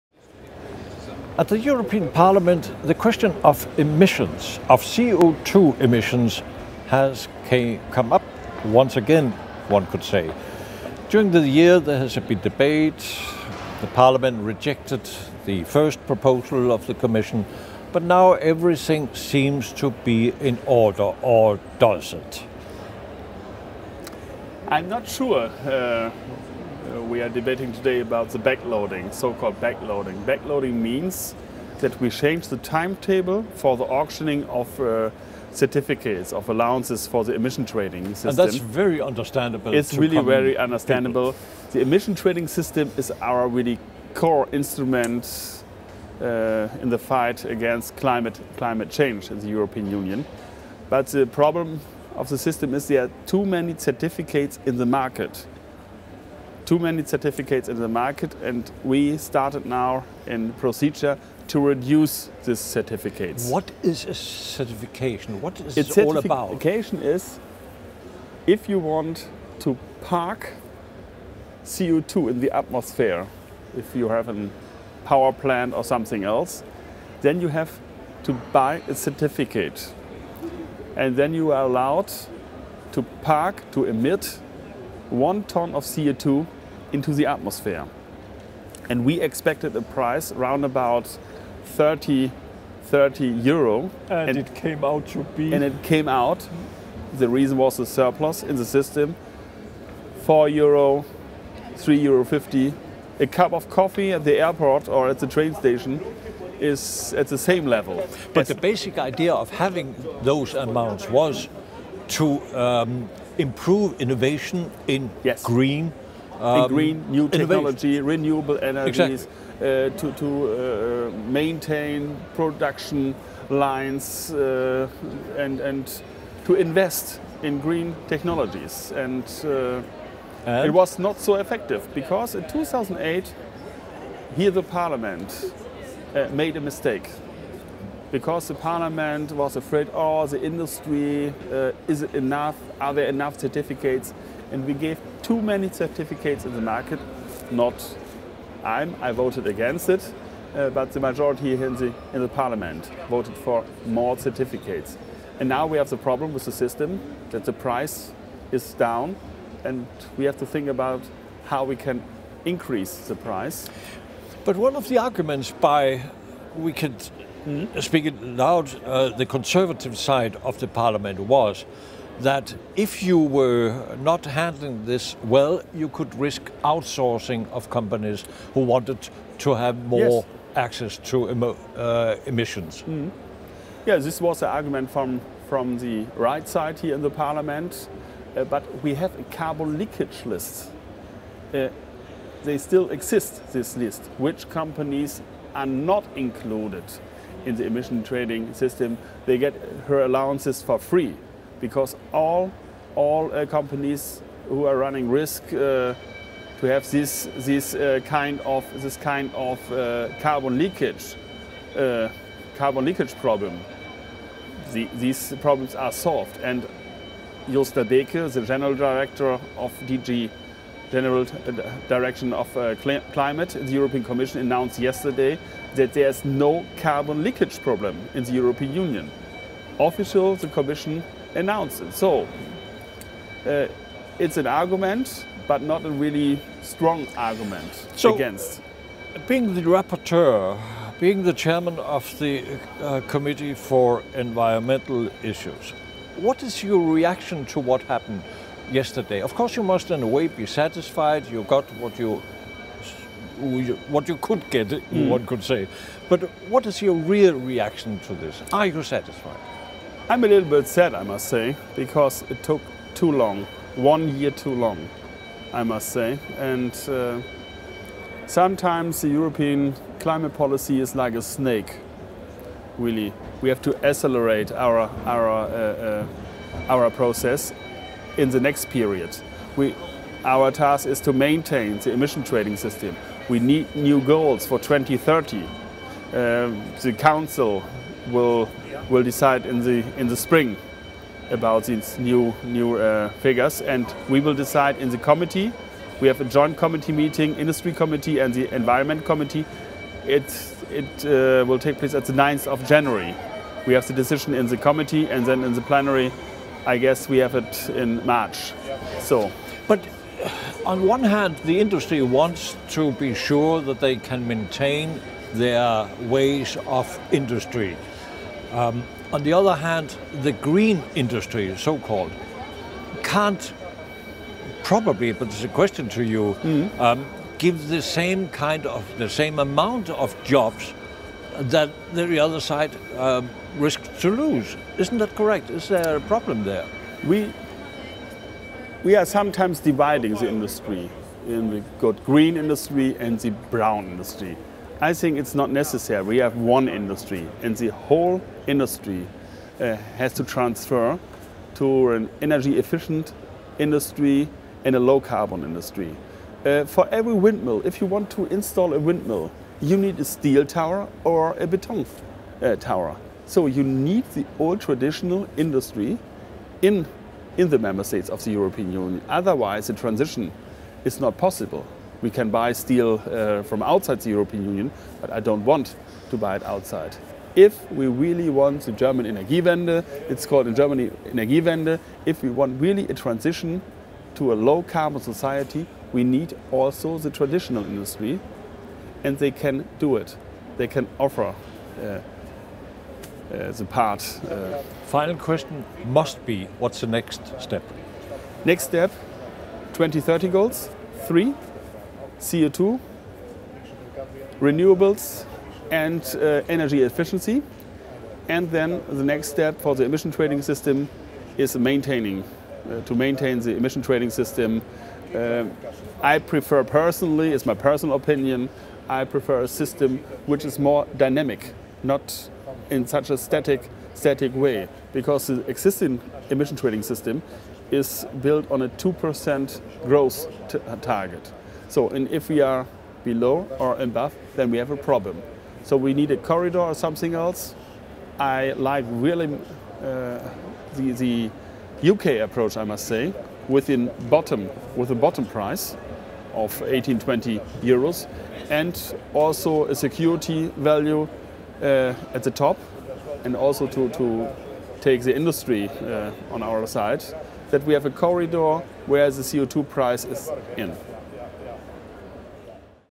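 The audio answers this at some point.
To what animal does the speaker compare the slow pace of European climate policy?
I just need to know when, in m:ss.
4:31.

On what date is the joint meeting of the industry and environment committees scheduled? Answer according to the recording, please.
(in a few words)
9 January.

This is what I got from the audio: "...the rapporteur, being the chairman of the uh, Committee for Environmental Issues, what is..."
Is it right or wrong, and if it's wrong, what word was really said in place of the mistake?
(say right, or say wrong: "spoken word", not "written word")
right.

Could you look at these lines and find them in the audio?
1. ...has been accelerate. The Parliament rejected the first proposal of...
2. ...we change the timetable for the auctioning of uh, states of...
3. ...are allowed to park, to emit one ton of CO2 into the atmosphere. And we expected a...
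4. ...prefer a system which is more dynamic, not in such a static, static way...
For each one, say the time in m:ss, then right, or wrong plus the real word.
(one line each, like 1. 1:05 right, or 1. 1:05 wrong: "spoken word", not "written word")
1. 0:11 wrong: "debate", not "accelerate"
2. 0:31 wrong: "certificates", not "states"
3. 1:21 right
4. 6:59 right.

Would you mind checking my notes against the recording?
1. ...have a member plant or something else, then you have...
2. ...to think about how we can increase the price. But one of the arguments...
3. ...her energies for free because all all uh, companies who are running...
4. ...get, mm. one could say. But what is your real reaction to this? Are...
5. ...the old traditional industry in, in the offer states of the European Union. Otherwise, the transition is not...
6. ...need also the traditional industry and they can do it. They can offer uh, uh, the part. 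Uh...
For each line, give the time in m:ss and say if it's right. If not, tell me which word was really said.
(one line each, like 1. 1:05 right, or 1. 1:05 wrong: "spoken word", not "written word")
1. 1:14 wrong: "power", not "member"
2. 2:40 right
3. 3:19 wrong: "allowances", not "energies"
4. 4:14 right
5. 6:04 wrong: "member", not "offer"
6. 6:26 right.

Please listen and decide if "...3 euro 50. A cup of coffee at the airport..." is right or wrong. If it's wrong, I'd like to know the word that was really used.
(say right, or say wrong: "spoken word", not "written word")
right.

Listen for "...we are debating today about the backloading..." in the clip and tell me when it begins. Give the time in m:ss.
0:27.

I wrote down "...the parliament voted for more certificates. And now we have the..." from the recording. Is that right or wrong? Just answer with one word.
right.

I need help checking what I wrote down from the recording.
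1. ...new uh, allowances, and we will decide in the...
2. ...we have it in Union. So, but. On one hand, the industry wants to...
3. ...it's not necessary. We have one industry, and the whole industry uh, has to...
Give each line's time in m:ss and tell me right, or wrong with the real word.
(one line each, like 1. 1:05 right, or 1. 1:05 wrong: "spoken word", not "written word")
1. 4:52 wrong: "figures", not "allowances"
2. 5:07 wrong: "March", not "Union"
3. 5:45 right.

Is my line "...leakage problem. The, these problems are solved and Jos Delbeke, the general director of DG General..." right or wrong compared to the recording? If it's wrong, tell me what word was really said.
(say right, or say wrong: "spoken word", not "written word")
right.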